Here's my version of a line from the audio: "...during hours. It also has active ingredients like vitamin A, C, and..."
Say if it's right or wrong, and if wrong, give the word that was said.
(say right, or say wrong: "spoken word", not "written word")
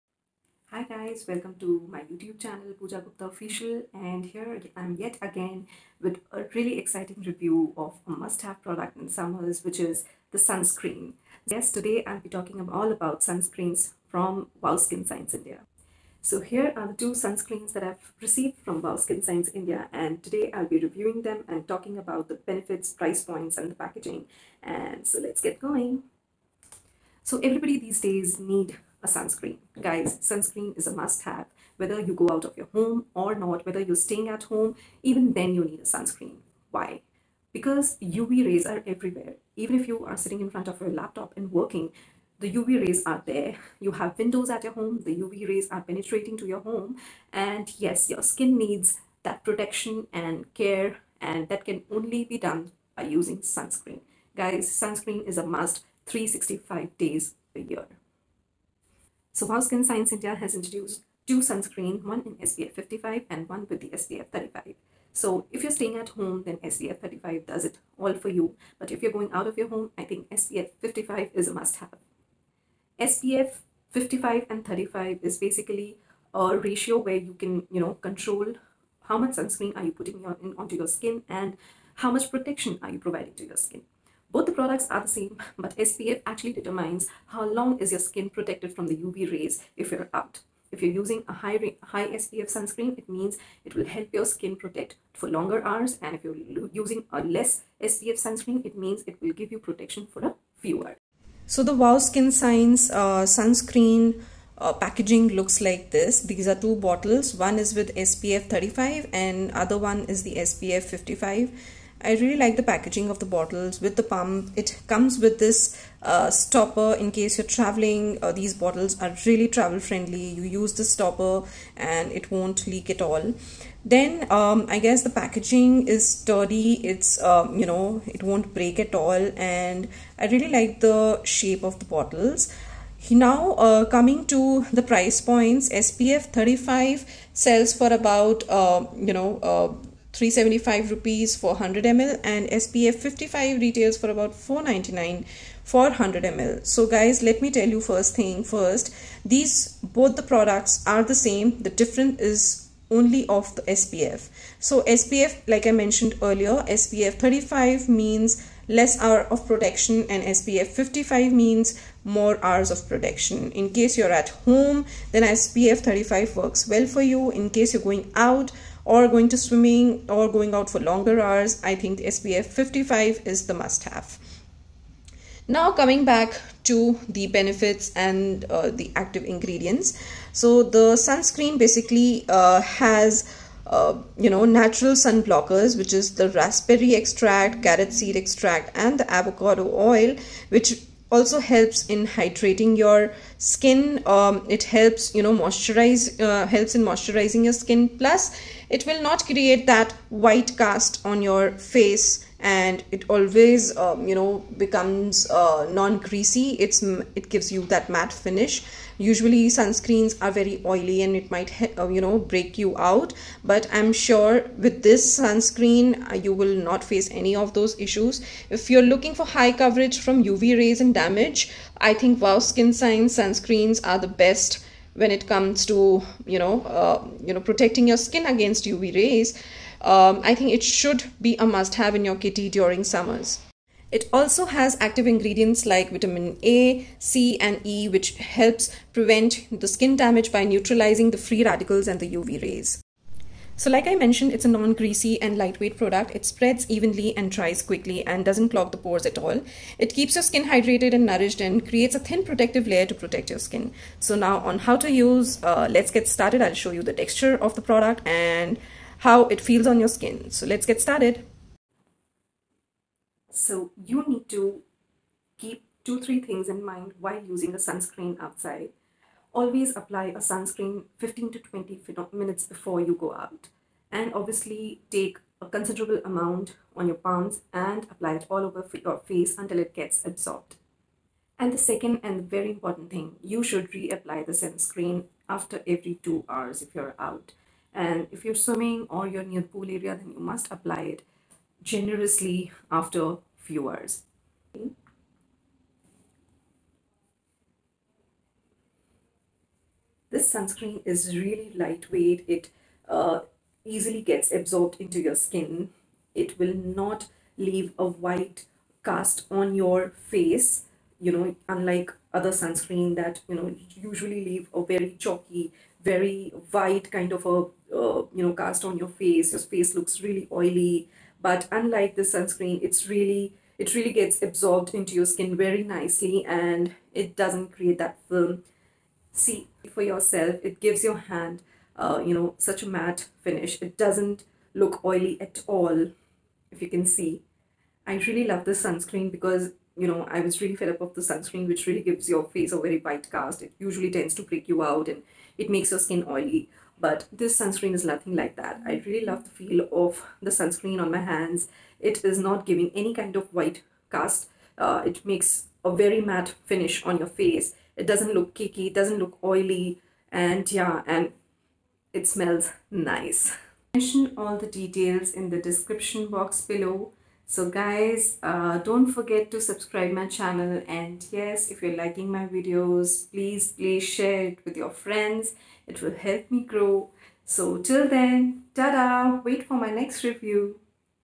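wrong: "summers", not "hours".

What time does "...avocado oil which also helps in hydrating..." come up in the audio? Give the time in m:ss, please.
3:09.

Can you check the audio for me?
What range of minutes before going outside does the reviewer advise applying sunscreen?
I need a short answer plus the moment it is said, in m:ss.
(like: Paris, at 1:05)
15 to 20 minutes, at 4:30.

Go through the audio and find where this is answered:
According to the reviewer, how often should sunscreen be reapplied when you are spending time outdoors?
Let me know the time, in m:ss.
4:45.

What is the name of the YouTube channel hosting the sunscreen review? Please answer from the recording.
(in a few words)
Pooja Gupta Official.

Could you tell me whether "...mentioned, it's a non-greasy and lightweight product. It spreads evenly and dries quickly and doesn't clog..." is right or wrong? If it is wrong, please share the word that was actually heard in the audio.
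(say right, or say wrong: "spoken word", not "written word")
right.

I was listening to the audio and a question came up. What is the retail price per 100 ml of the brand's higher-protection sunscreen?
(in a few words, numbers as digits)
499.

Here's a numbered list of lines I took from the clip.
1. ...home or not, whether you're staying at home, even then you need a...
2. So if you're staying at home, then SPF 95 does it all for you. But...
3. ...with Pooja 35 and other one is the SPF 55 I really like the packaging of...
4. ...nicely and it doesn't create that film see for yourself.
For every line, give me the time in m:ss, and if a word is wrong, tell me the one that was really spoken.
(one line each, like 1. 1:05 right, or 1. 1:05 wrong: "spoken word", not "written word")
1. 0:32 right
2. 1:05 wrong: "35", not "95"
3. 1:47 wrong: "SPF", not "Pooja"
4. 5:25 right.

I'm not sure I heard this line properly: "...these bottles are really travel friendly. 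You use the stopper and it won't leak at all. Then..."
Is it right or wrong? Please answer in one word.
right.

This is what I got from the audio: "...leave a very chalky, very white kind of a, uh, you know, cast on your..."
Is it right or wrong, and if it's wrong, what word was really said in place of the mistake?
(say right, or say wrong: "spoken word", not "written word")
right.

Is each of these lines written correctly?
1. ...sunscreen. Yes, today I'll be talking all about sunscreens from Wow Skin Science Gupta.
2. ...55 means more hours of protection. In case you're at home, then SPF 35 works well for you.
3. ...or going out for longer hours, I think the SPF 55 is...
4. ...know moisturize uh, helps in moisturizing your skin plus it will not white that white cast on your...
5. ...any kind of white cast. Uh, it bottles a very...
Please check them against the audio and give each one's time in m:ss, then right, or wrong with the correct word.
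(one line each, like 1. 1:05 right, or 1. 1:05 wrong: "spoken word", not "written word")
1. 0:10 wrong: "India", not "Gupta"
2. 2:40 right
3. 2:50 right
4. 3:15 wrong: "create", not "white"
5. 5:52 wrong: "makes", not "bottles".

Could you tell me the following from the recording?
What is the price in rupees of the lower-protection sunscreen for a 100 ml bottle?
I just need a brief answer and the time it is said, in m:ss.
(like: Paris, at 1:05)
375 rupees, at 2:20.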